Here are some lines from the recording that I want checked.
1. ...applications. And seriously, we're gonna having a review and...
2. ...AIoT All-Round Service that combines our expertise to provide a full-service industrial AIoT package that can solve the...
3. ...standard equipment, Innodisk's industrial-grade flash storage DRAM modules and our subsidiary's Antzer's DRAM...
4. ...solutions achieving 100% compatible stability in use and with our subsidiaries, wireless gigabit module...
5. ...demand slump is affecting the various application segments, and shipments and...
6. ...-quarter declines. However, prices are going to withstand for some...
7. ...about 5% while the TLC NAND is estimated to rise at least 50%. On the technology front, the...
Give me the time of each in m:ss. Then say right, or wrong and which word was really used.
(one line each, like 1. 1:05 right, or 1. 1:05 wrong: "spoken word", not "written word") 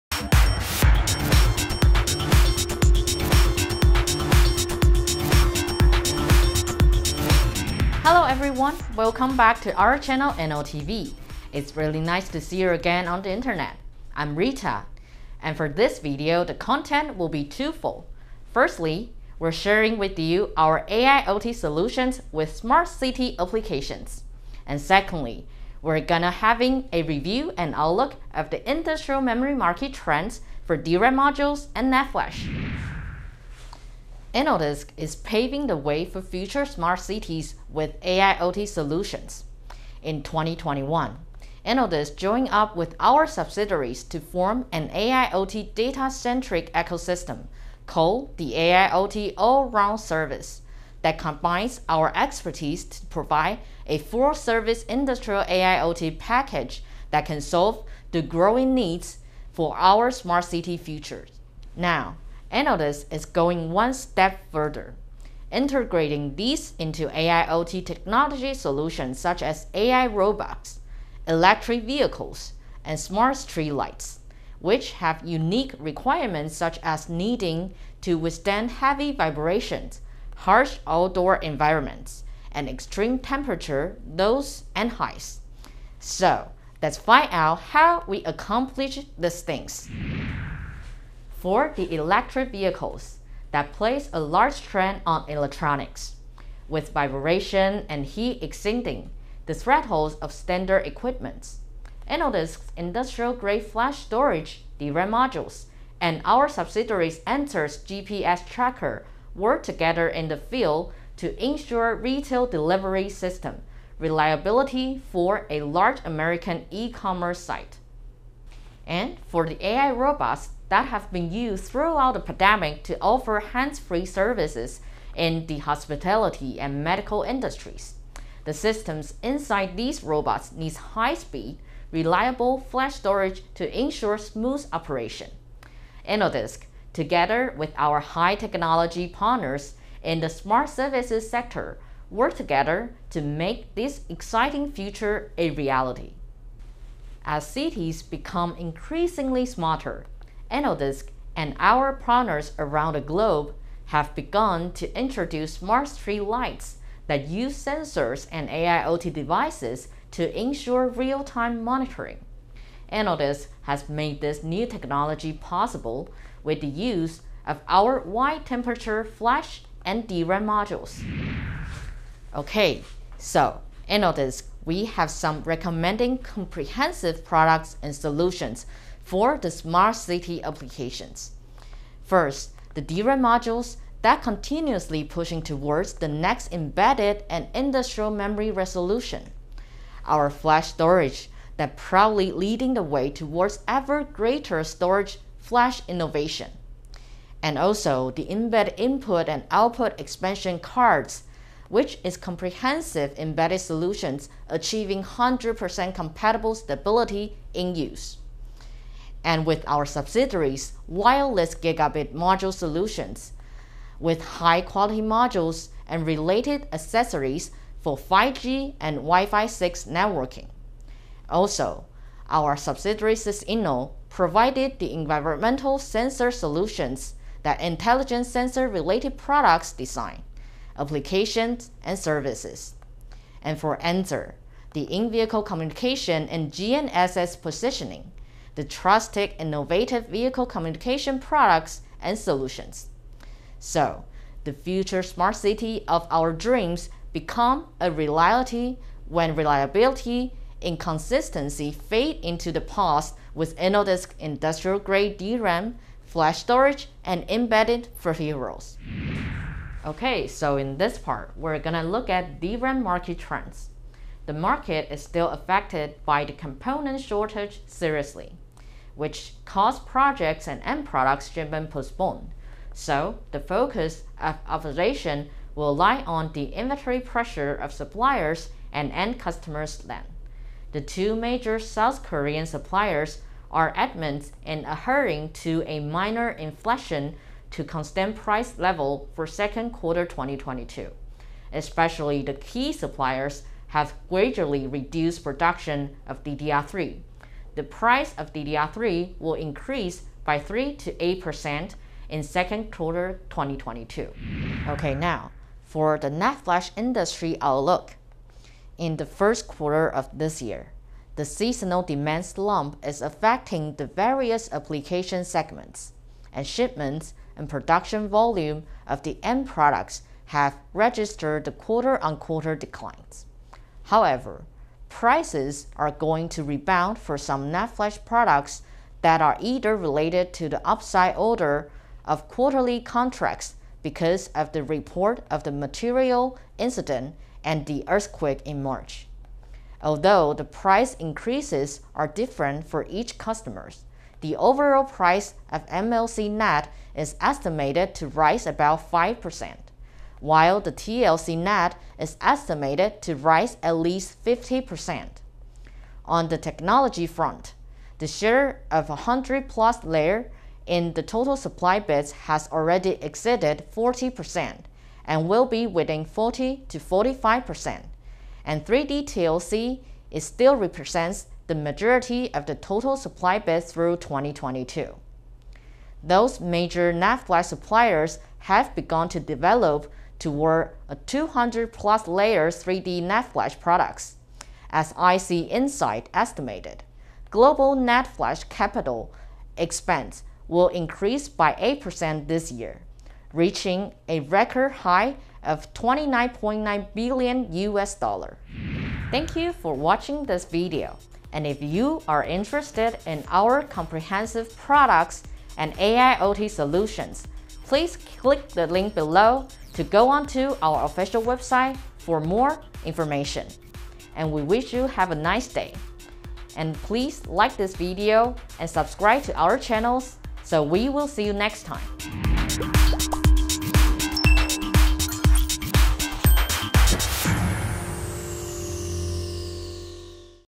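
1. 0:23 wrong: "secondly", not "seriously"
2. 0:48 right
3. 1:40 wrong: "GPS", not "DRAM"
4. 3:23 right
5. 5:11 right
6. 5:22 wrong: "rebound", not "withstand"
7. 5:48 right.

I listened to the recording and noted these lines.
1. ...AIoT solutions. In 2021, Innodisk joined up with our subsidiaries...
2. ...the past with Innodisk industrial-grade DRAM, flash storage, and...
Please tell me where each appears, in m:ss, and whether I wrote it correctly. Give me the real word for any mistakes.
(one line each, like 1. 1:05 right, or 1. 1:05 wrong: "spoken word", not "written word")
1. 0:37 right
2. 4:12 right.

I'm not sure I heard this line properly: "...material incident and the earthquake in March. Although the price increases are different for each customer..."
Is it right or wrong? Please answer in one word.
right.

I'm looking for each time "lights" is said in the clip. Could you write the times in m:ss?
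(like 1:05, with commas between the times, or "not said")
1:13, 2:36.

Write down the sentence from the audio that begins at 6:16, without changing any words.
Those major NAND flash suppliers have begun to develop toward a 200 plus layer 3D NAND flash products.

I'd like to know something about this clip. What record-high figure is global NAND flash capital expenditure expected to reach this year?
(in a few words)
29.9 billion US dollars.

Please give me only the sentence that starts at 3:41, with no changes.
Also, our subsidiary Sysinno provided the environmental sensor solutions that intelligent sensor related products design, applications, and services.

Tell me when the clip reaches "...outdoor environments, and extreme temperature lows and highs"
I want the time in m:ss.
1:20.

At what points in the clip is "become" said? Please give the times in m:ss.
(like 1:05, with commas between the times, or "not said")
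2:28, 4:07.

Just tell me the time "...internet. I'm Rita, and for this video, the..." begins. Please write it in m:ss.
0:13.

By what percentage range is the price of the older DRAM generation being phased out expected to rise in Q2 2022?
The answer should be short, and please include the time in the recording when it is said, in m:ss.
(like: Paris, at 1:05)
3 to 8%, at 5:00.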